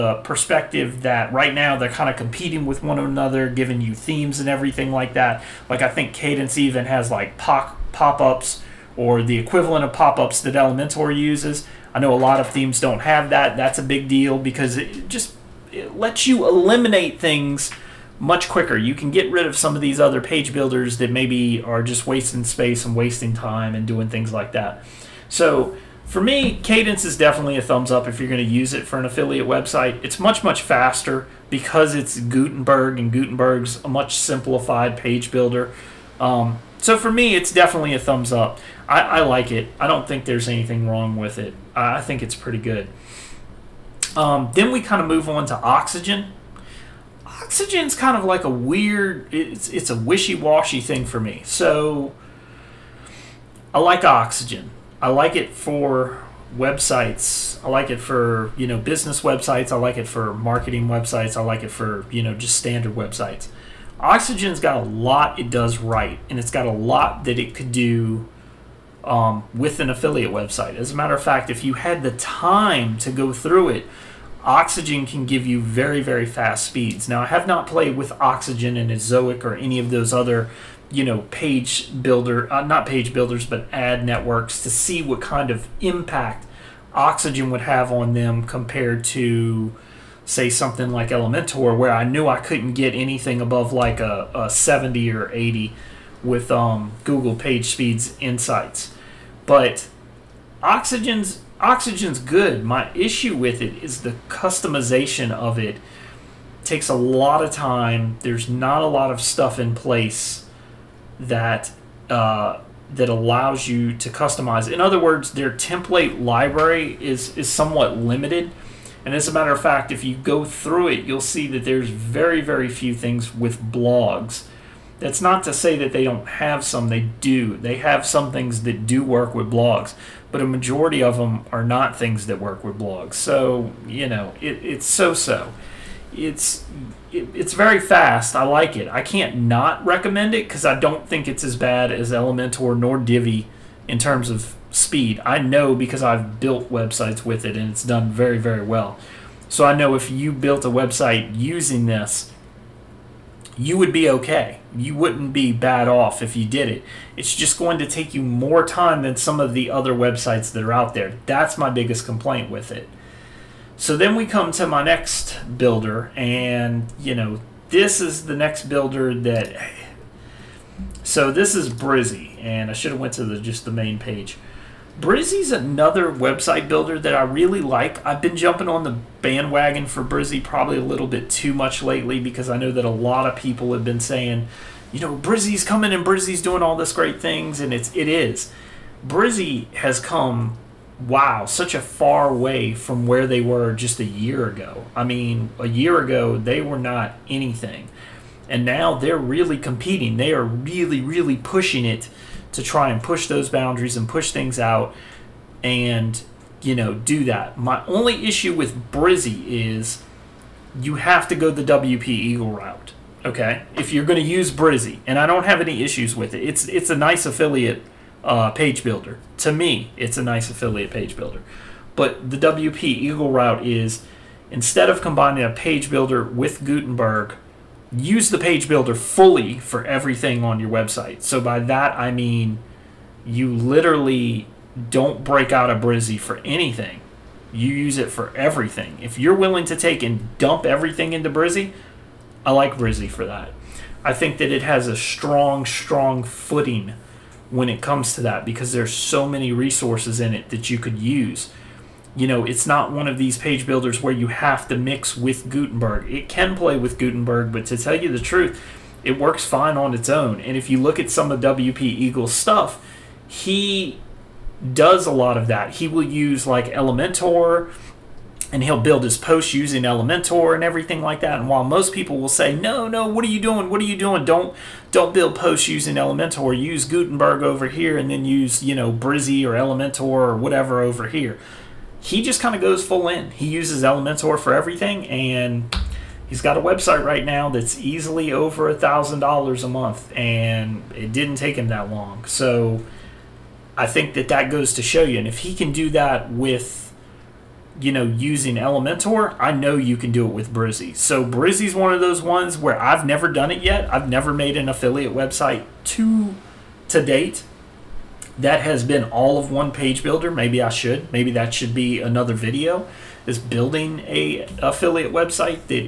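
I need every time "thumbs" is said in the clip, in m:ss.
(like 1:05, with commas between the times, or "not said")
0:27, 0:37.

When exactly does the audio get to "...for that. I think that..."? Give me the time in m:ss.
4:03.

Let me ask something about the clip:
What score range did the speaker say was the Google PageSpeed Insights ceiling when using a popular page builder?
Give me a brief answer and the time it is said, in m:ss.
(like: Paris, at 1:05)
70 or 80, at 1:34.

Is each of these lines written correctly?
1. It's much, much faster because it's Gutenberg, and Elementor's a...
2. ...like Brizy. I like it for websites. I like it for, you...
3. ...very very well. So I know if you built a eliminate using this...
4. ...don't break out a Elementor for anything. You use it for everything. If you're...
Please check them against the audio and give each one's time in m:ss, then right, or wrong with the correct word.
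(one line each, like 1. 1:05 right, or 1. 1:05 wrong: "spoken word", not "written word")
1. 0:30 wrong: "Gutenberg", not "Elementor"
2. 0:53 wrong: "Oxygen", not "Brizy"
3. 2:28 wrong: "website", not "eliminate"
4. 3:54 wrong: "Brizy", not "Elementor".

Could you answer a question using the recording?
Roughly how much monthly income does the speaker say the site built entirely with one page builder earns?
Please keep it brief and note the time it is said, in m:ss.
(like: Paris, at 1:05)
over $1,000 a month, at 4:48.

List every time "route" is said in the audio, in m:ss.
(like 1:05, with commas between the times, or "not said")
3:32, 3:43.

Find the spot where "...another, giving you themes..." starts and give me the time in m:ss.
0:02.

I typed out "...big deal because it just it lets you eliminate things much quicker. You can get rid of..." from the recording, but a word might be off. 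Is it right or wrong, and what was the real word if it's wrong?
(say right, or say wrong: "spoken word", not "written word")
right.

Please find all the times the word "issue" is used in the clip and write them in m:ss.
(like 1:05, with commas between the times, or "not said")
1:42, 3:28, 3:35.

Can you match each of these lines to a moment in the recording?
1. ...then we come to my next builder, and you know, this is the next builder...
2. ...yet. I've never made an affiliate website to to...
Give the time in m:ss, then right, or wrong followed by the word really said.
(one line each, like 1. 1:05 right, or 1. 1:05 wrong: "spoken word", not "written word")
1. 2:43 right
2. 5:03 right.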